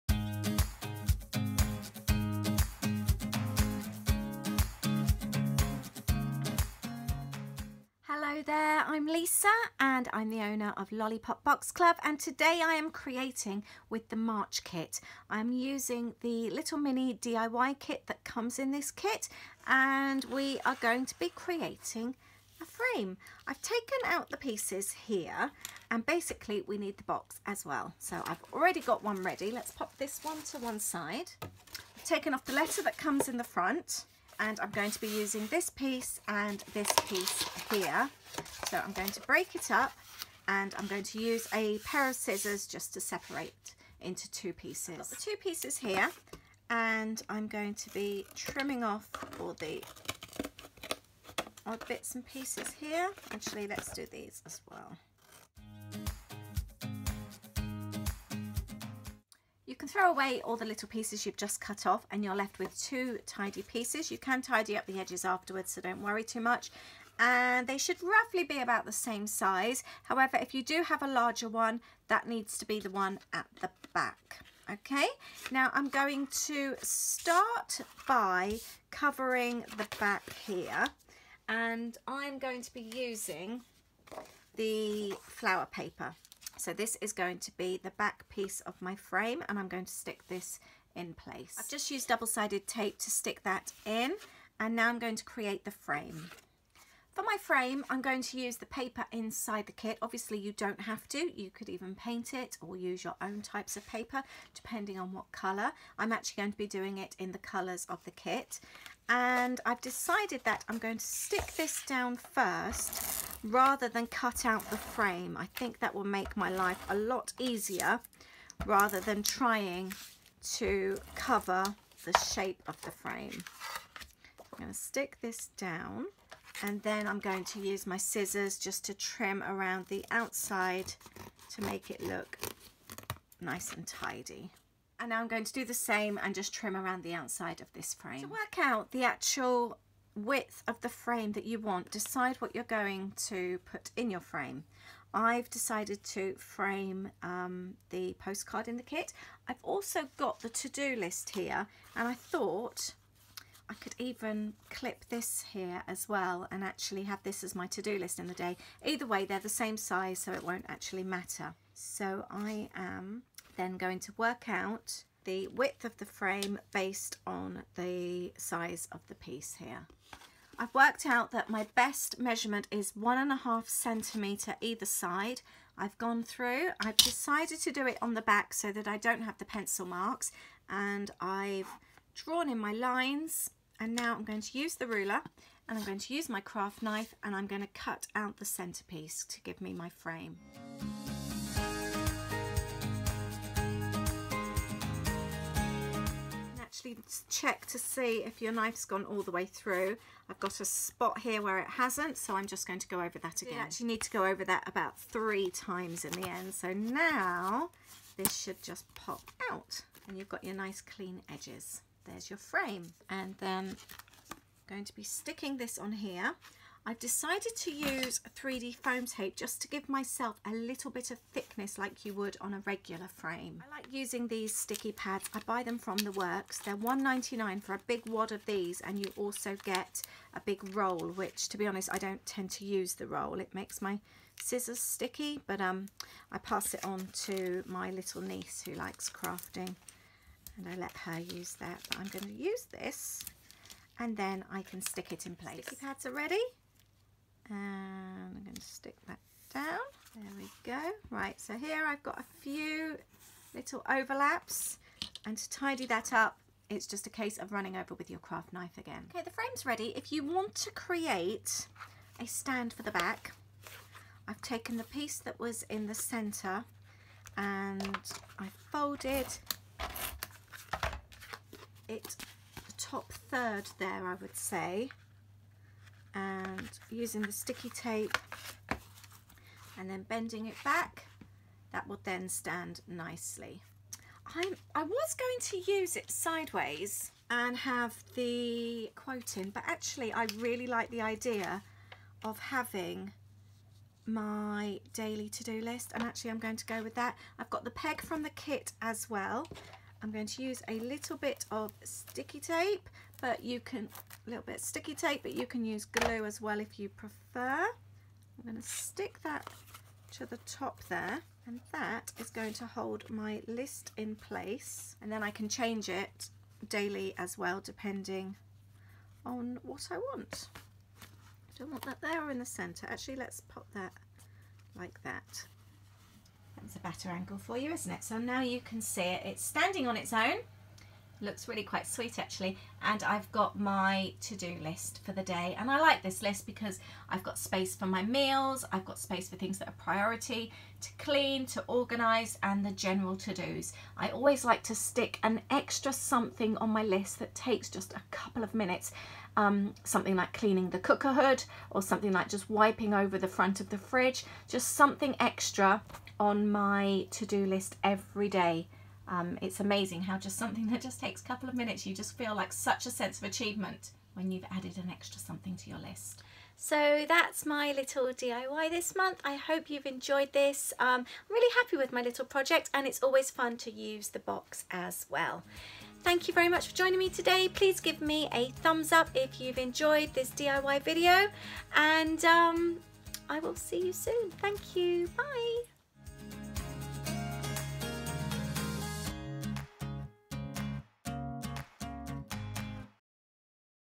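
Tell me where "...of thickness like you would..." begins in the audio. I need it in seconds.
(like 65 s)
221 s.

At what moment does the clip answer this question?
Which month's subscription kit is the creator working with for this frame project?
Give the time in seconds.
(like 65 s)
14 s.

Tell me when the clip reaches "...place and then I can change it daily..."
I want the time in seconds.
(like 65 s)
314 s.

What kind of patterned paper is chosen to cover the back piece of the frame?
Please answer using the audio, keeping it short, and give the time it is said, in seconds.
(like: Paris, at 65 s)
flower paper, at 85 s.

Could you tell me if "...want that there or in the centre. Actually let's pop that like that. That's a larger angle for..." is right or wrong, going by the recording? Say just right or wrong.
wrong.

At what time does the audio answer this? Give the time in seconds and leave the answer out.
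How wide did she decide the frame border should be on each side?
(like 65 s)
172 s.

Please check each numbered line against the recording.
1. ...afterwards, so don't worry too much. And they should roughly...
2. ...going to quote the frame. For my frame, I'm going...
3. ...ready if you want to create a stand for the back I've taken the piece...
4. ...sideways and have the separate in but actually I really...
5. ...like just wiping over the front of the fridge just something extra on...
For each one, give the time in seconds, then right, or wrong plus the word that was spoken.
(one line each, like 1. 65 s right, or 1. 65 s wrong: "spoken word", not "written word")
1. 65 s right
2. 94 s wrong: "create", not "quote"
3. 259 s right
4. 286 s wrong: "quote", not "separate"
5. 352 s right.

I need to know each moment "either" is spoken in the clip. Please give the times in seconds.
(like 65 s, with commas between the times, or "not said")
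158 s, 174 s.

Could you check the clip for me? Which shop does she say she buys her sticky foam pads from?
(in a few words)
The Works.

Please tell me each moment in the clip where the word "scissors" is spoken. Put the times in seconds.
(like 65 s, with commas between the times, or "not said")
42 s, 127 s, 234 s.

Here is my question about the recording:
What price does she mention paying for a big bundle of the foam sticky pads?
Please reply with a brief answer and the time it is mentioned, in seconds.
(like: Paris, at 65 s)
$1.99, at 226 s.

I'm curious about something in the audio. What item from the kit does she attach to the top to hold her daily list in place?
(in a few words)
peg.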